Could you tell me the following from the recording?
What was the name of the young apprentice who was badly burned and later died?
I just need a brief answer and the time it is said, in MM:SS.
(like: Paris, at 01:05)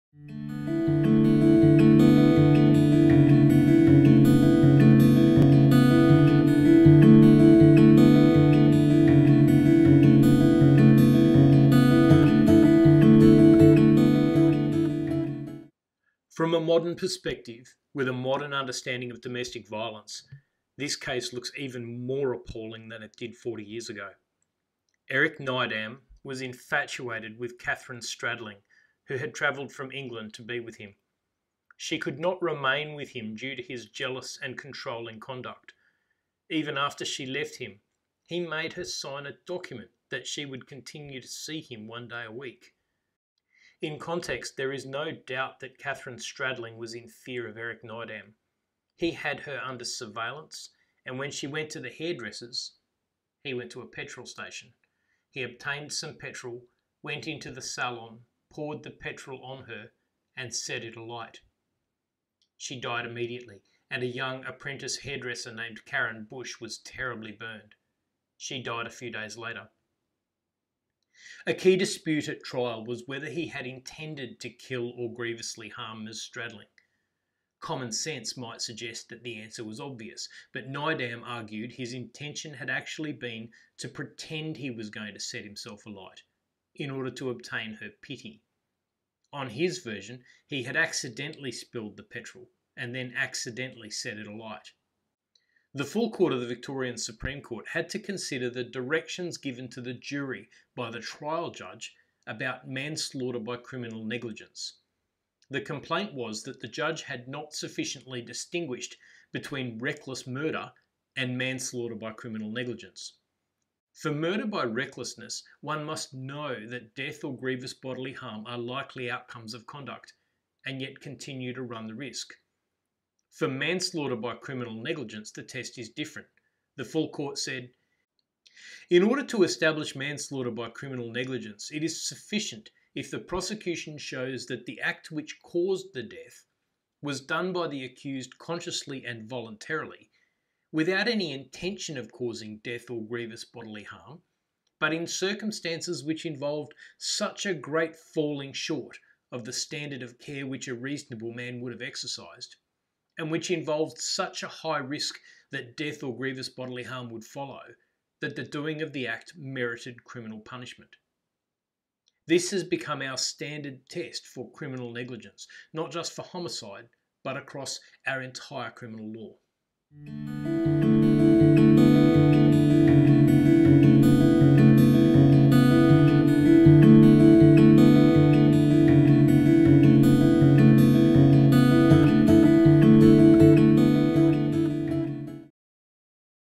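Karen Bush, at 01:05.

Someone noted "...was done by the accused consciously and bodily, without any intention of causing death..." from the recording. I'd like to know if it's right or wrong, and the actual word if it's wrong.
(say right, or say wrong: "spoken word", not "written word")
wrong: "voluntarily", not "bodily".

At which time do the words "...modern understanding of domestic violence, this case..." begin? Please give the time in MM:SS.
00:18.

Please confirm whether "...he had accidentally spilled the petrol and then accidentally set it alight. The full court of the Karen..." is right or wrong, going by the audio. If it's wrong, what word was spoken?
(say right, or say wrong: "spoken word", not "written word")
wrong: "Victorian", not "Karen".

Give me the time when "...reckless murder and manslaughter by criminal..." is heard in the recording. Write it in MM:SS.
01:49.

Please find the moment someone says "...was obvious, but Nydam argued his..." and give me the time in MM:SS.
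01:19.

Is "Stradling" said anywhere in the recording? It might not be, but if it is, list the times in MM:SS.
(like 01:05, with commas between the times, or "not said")
00:28, 00:46, 01:16.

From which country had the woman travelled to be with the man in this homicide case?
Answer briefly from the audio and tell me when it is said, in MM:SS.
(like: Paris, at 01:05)
England, at 00:29.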